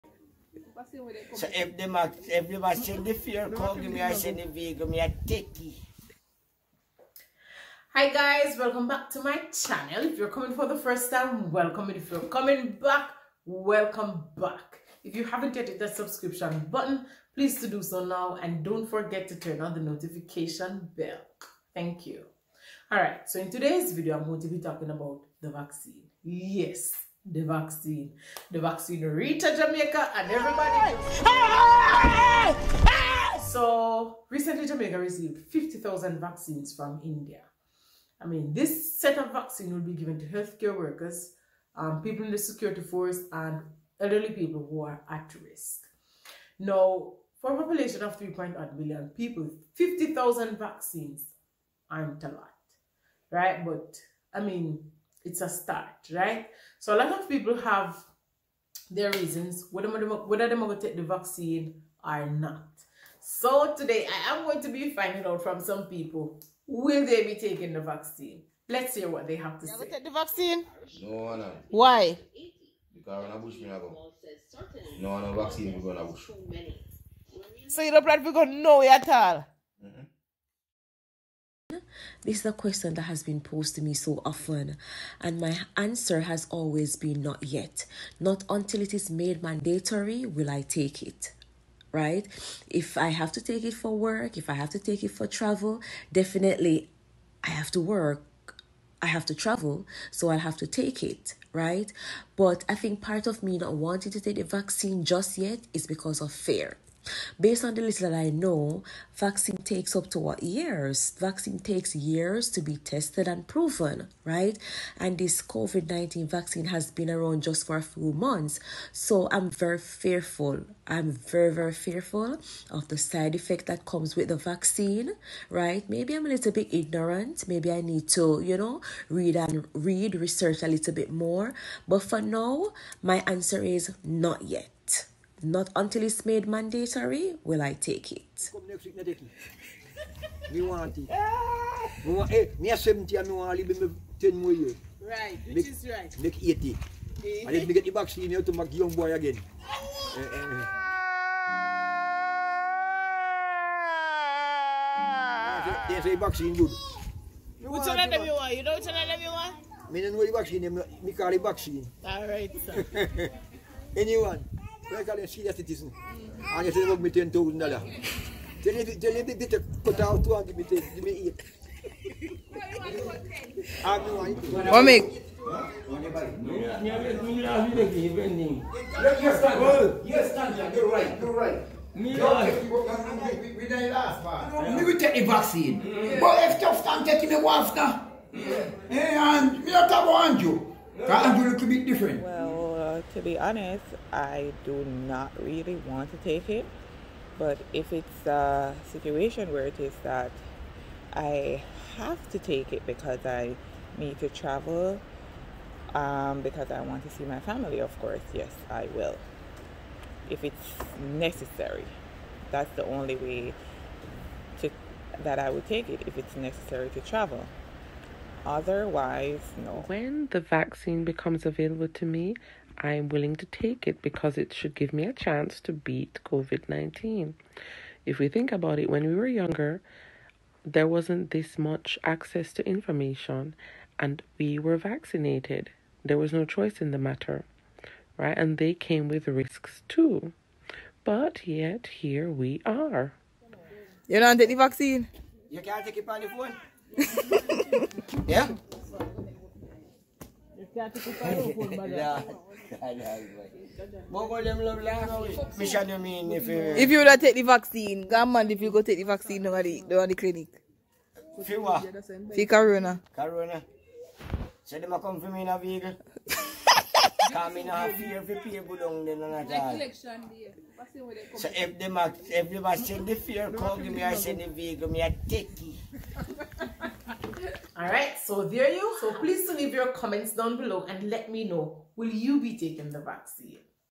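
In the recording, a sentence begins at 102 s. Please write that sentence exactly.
But I think part of me not wanting to take the vaccine just yet is because of fear.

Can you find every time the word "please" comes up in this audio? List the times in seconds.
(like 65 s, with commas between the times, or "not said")
17 s, 279 s.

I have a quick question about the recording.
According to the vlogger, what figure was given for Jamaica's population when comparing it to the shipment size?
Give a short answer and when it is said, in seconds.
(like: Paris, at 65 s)
3.8 billion, at 48 s.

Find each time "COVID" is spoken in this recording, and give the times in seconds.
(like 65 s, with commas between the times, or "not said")
115 s, 226 s.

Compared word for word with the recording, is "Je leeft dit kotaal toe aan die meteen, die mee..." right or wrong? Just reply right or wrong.
right.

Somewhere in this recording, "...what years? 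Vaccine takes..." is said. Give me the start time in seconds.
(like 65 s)
110 s.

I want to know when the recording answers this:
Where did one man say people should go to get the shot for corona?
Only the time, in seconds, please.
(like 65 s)
260 s.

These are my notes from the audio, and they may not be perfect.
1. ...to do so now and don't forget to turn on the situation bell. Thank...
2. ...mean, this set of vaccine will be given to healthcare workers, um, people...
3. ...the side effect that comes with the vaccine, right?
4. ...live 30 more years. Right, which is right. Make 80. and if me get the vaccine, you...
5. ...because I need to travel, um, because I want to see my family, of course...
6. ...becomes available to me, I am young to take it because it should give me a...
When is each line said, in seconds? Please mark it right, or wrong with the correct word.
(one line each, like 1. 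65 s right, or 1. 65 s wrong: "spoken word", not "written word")
1. 17 s wrong: "notification", not "situation"
2. 38 s right
3. 122 s right
4. 143 s wrong: "10", not "30"
5. 202 s right
6. 221 s wrong: "willing", not "young".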